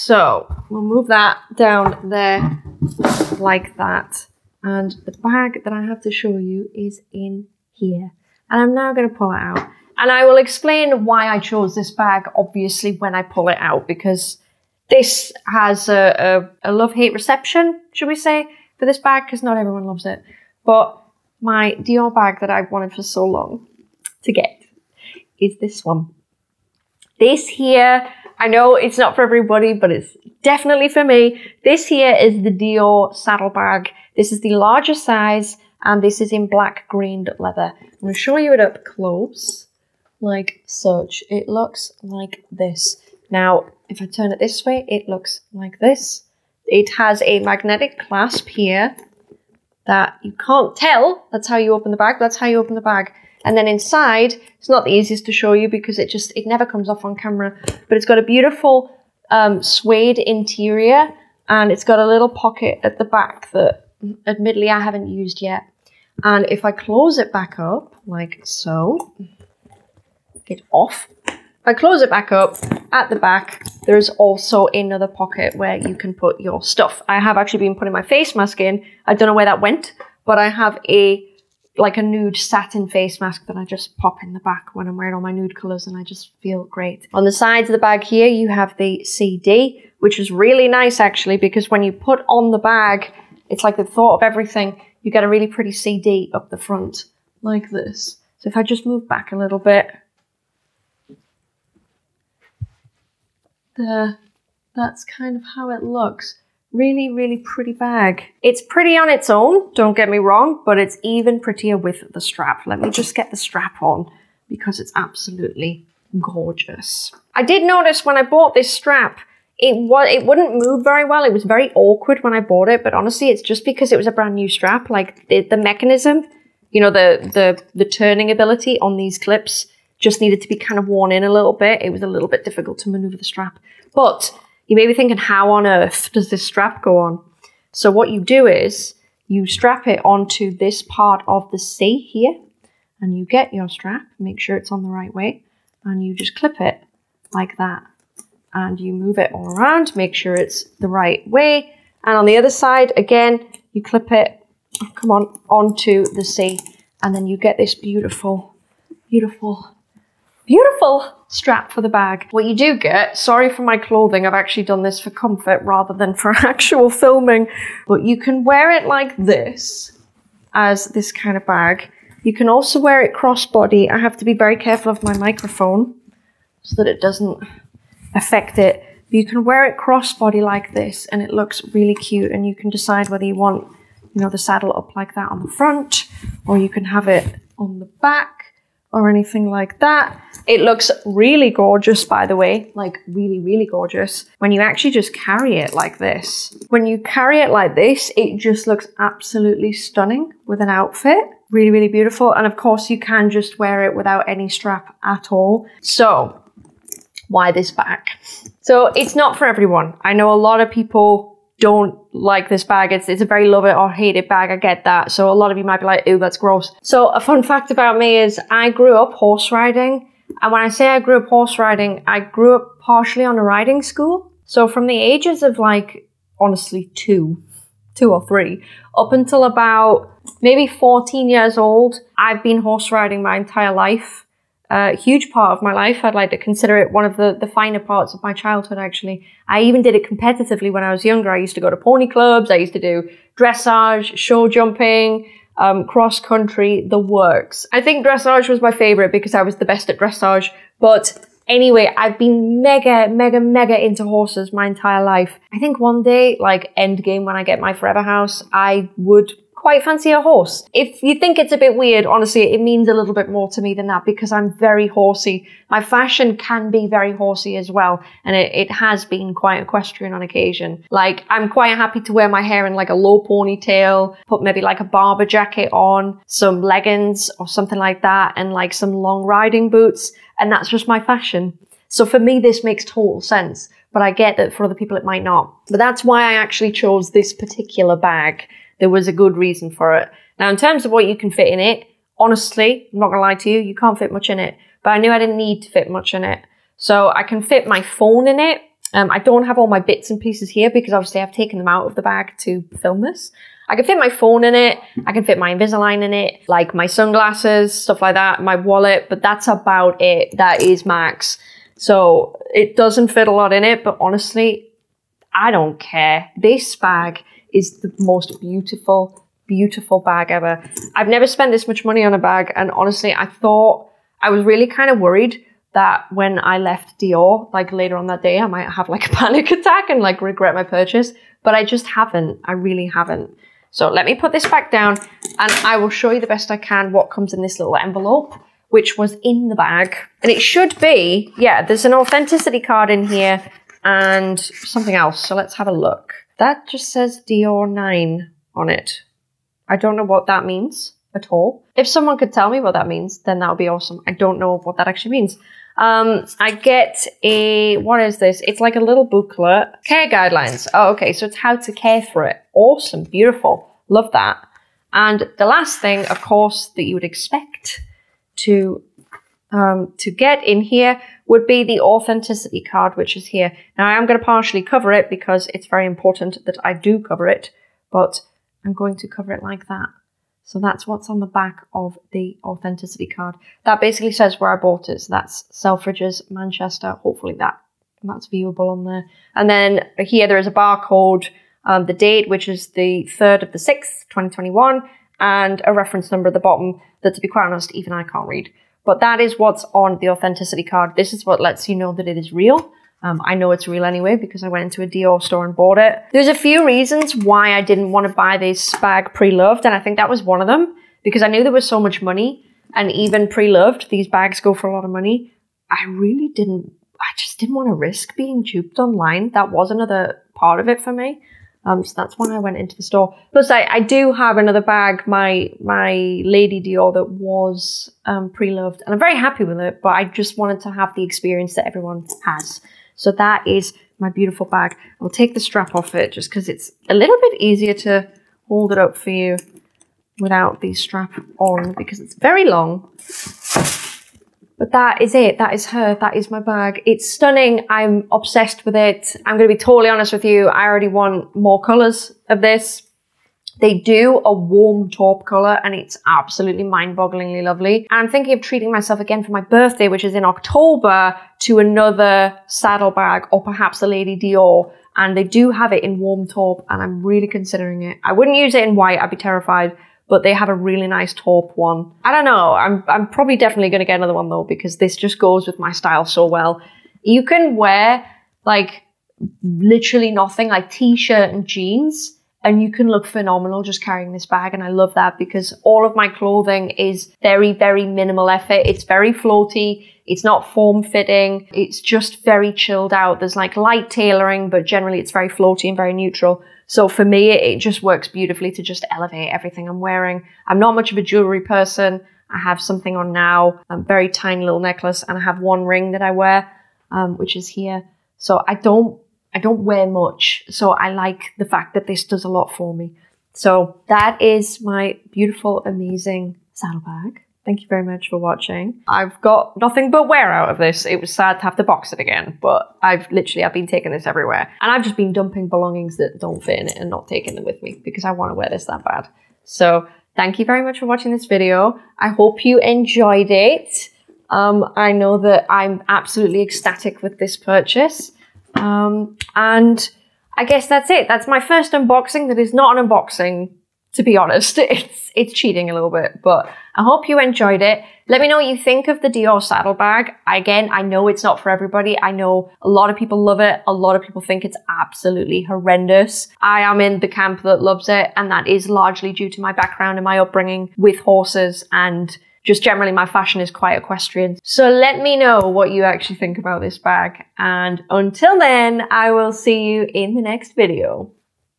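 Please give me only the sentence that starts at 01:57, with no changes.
I did notice when I bought this strap, it was it wouldn't move very well.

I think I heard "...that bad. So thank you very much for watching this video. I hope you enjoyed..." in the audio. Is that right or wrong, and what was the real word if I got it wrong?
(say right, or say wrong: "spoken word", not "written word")
right.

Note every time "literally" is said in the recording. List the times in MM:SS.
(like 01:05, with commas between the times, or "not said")
07:59, 08:43.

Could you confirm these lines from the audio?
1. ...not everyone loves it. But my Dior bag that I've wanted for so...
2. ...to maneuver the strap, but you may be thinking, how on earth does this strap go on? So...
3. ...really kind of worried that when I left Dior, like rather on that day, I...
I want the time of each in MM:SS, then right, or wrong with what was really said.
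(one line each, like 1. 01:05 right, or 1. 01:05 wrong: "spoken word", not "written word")
1. 00:19 right
2. 02:12 right
3. 05:24 wrong: "later", not "rather".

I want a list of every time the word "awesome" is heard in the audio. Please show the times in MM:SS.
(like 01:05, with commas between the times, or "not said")
05:53, 06:02.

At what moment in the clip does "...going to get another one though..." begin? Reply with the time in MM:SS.
07:53.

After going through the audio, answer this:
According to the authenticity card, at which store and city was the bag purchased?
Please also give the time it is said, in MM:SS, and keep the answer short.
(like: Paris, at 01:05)
Selfridges, Manchester, at 06:25.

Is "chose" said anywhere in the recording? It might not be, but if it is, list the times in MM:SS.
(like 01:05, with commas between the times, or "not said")
00:11, 04:46.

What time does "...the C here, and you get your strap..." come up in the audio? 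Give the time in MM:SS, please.
02:21.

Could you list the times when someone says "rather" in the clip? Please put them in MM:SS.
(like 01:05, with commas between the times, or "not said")
02:45.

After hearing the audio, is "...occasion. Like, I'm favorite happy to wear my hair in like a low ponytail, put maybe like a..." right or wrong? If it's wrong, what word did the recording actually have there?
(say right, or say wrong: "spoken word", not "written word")
wrong: "quite", not "favorite".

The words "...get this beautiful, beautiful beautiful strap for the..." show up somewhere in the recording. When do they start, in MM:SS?
02:37.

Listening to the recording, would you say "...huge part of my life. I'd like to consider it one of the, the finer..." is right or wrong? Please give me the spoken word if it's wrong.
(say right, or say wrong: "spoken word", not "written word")
right.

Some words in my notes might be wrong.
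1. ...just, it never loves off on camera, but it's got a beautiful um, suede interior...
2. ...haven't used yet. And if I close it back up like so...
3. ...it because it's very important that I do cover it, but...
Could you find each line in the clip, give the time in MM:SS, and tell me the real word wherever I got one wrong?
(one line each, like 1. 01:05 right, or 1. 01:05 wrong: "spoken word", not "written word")
1. 00:56 wrong: "comes", not "loves"
2. 01:04 right
3. 06:14 right.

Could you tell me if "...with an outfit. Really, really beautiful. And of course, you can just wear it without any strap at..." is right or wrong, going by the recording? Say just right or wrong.
right.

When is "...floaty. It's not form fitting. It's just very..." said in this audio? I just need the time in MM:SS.
08:09.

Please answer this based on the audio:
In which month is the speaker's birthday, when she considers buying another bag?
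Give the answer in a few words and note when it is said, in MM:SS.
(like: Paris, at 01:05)
October, at 07:40.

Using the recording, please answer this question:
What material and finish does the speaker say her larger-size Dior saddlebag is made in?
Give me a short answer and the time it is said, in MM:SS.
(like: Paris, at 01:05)
black grained leather, at 00:36.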